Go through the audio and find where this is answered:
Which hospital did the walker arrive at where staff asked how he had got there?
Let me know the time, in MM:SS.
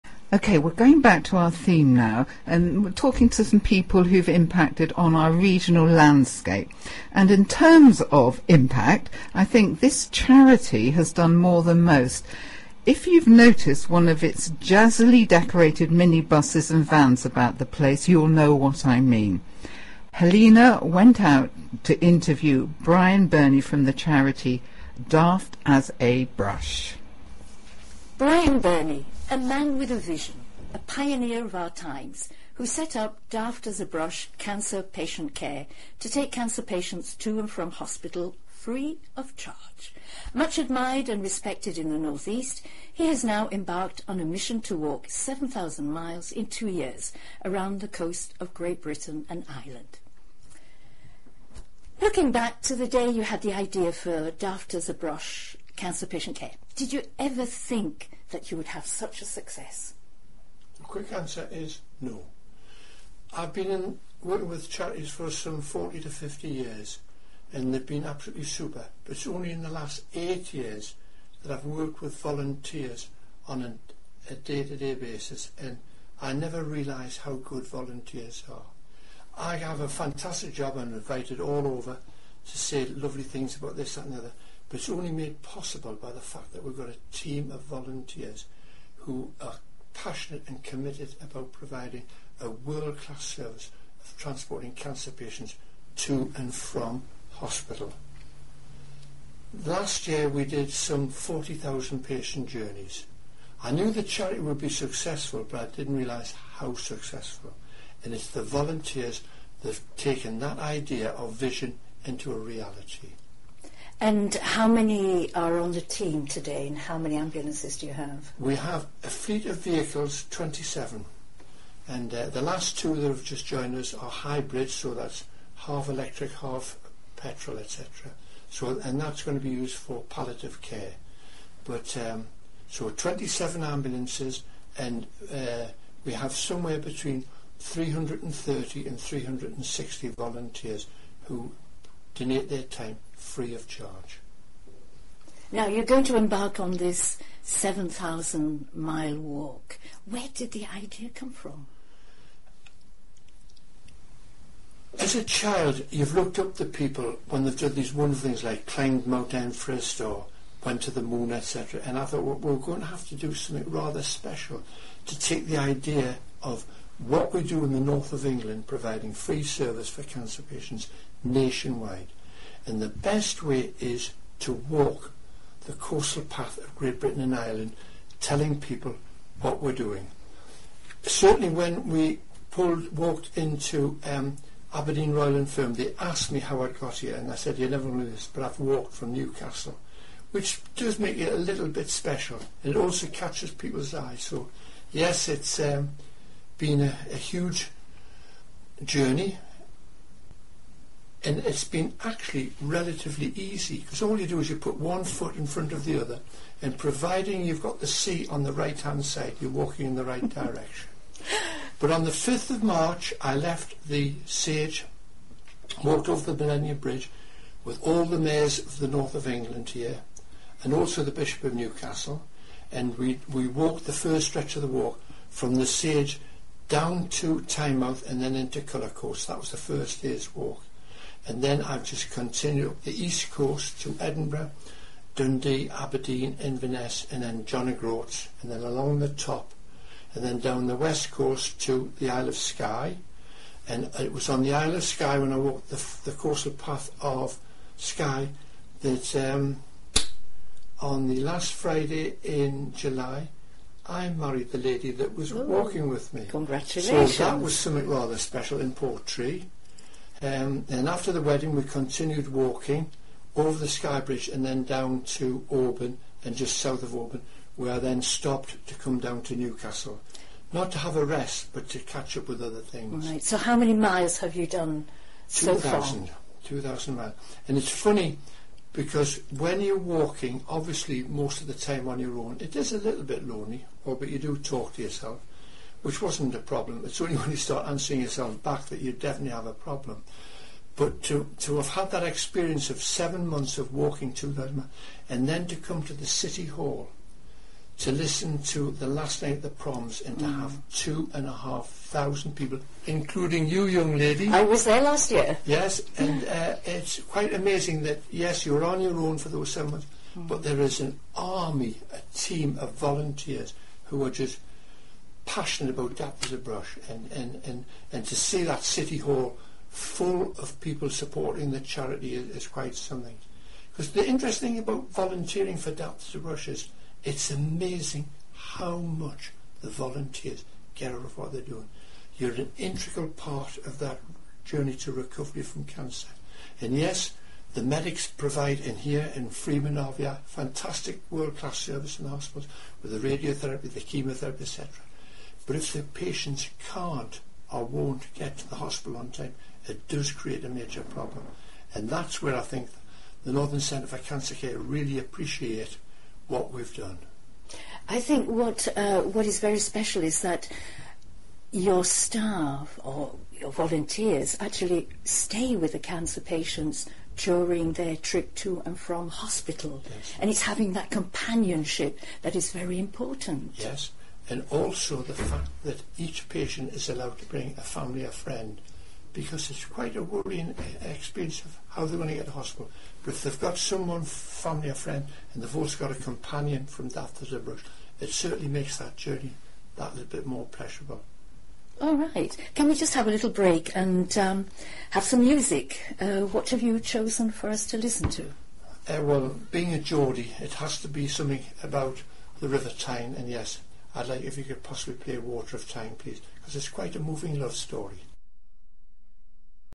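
03:04.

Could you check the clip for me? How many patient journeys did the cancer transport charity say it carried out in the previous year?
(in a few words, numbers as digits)
40,000.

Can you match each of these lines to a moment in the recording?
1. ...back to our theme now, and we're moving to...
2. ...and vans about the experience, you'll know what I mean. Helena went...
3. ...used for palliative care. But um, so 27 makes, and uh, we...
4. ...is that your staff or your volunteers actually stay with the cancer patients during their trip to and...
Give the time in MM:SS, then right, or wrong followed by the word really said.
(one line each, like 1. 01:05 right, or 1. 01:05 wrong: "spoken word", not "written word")
1. 00:01 wrong: "talking", not "moving"
2. 00:16 wrong: "place", not "experience"
3. 02:09 wrong: "ambulances", not "makes"
4. 06:00 right.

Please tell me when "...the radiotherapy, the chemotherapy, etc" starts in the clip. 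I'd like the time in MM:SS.
05:42.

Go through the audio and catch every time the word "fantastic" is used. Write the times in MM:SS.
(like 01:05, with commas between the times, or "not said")
01:19, 05:40.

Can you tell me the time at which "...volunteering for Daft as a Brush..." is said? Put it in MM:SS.
05:24.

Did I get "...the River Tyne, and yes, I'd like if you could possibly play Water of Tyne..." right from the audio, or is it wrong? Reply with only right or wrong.
right.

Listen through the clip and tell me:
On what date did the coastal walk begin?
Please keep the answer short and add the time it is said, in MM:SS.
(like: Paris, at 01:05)
5th of March, at 03:32.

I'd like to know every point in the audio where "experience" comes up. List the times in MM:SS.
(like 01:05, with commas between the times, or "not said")
04:52, 06:20.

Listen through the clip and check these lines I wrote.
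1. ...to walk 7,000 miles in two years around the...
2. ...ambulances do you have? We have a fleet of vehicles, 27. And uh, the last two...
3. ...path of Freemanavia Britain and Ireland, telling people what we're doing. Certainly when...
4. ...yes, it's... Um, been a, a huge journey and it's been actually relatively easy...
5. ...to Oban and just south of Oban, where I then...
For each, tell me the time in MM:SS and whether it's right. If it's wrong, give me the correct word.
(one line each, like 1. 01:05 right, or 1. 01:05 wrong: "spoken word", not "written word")
1. 00:44 right
2. 01:57 right
3. 02:56 wrong: "Great", not "Freemanavia"
4. 03:14 right
5. 04:25 right.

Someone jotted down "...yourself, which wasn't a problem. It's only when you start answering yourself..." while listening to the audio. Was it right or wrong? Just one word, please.
right.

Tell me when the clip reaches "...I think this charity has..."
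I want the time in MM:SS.
00:09.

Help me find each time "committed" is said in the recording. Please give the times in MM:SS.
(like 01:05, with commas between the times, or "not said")
01:30.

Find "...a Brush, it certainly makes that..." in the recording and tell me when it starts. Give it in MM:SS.
06:27.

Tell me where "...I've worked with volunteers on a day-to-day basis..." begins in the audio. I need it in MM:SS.
01:11.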